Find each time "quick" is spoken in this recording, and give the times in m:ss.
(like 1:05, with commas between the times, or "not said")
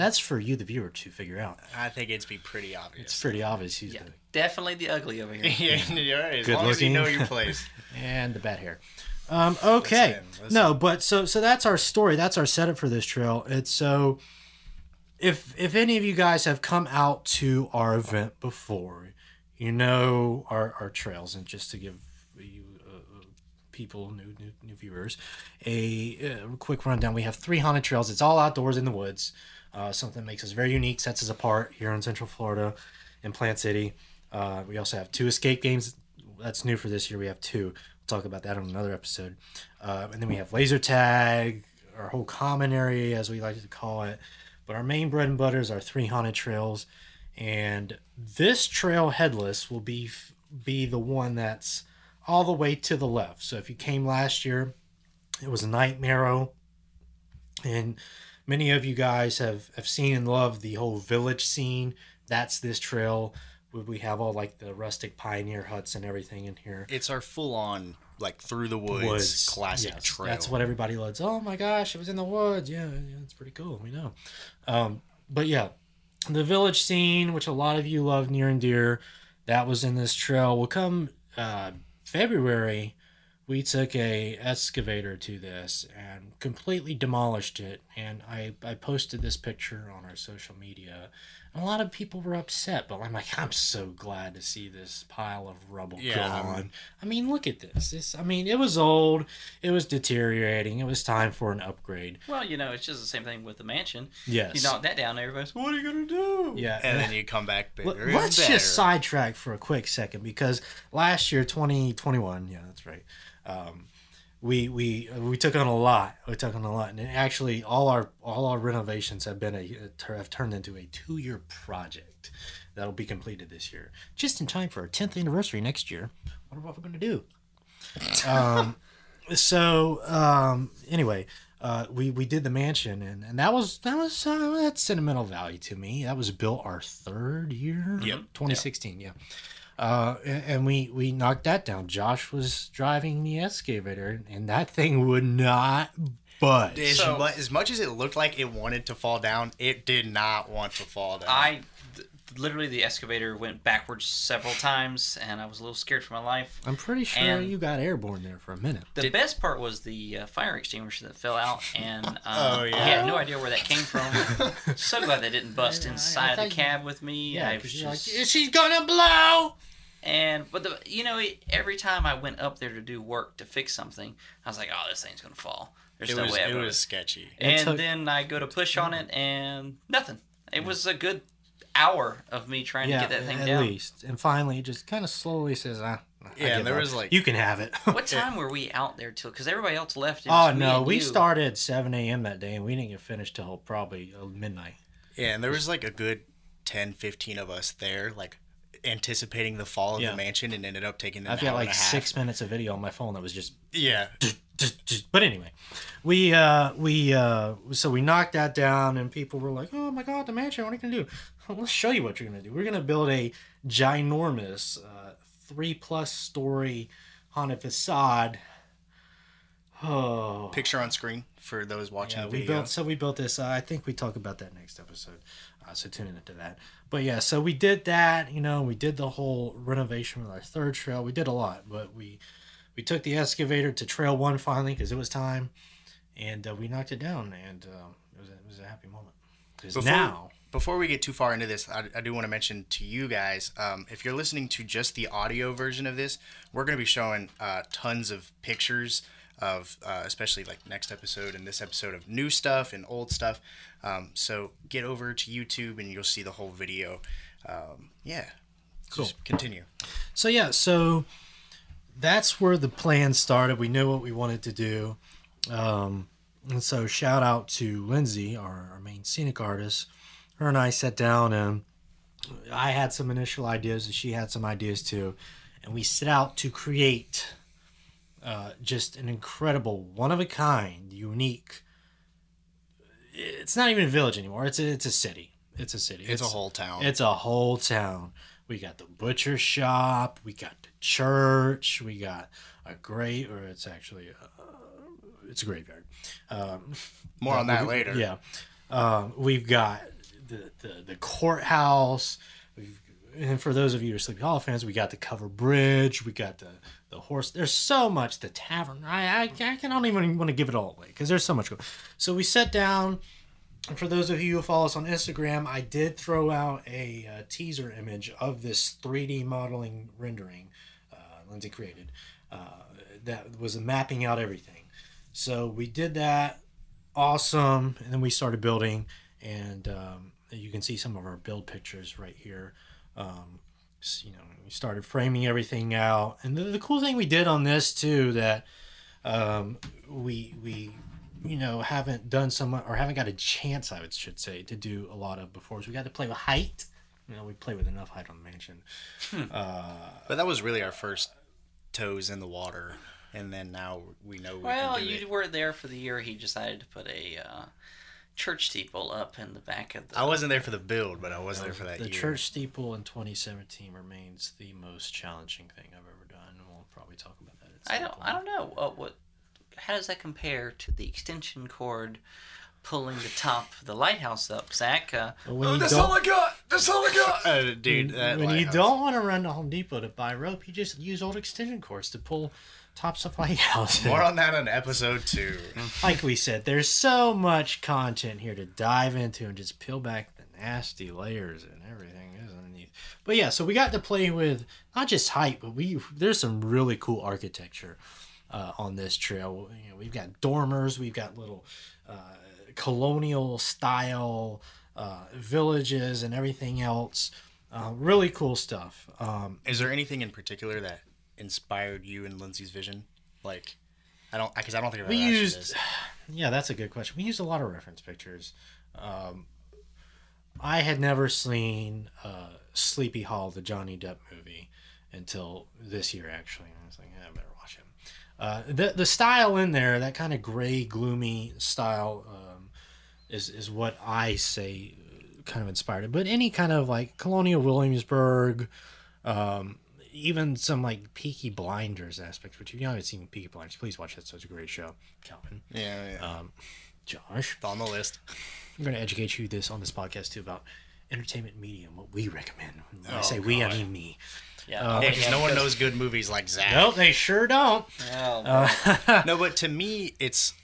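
0:26, 1:49.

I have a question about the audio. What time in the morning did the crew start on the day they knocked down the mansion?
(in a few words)
7 a.m.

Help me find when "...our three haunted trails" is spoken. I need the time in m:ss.
0:45.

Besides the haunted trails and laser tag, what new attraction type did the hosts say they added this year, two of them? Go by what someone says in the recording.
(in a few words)
Escape games.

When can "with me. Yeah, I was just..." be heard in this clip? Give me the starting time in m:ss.
2:46.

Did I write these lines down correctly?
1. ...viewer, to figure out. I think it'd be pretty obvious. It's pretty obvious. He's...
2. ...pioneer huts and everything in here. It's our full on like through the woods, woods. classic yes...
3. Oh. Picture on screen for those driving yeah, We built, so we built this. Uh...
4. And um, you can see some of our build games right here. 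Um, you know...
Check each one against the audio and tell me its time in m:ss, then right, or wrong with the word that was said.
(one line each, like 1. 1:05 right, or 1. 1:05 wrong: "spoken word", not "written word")
1. 0:00 right
2. 1:05 right
3. 3:39 wrong: "watching", not "driving"
4. 5:29 wrong: "pictures", not "games".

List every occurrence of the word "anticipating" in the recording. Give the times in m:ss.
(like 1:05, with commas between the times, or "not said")
3:18.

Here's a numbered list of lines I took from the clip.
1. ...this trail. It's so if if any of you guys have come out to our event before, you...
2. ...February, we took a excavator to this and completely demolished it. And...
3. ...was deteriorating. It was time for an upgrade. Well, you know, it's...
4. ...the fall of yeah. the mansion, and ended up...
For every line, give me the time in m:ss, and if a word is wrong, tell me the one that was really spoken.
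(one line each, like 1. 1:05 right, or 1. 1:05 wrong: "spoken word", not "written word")
1. 0:12 right
2. 1:22 right
3. 1:39 right
4. 3:19 right.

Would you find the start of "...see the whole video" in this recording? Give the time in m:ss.
4:16.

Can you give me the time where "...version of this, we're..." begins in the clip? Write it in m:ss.
4:05.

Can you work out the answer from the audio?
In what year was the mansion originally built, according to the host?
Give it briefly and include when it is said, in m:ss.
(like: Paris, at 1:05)
2016, at 2:18.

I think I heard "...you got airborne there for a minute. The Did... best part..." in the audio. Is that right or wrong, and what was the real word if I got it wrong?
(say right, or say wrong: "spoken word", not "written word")
right.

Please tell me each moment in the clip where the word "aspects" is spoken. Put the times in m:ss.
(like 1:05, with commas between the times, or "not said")
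7:21.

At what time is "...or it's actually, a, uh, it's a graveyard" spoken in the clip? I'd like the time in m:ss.
4:53.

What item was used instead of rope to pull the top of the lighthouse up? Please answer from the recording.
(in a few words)
Old extension cords.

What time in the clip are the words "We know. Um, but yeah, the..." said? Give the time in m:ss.
1:13.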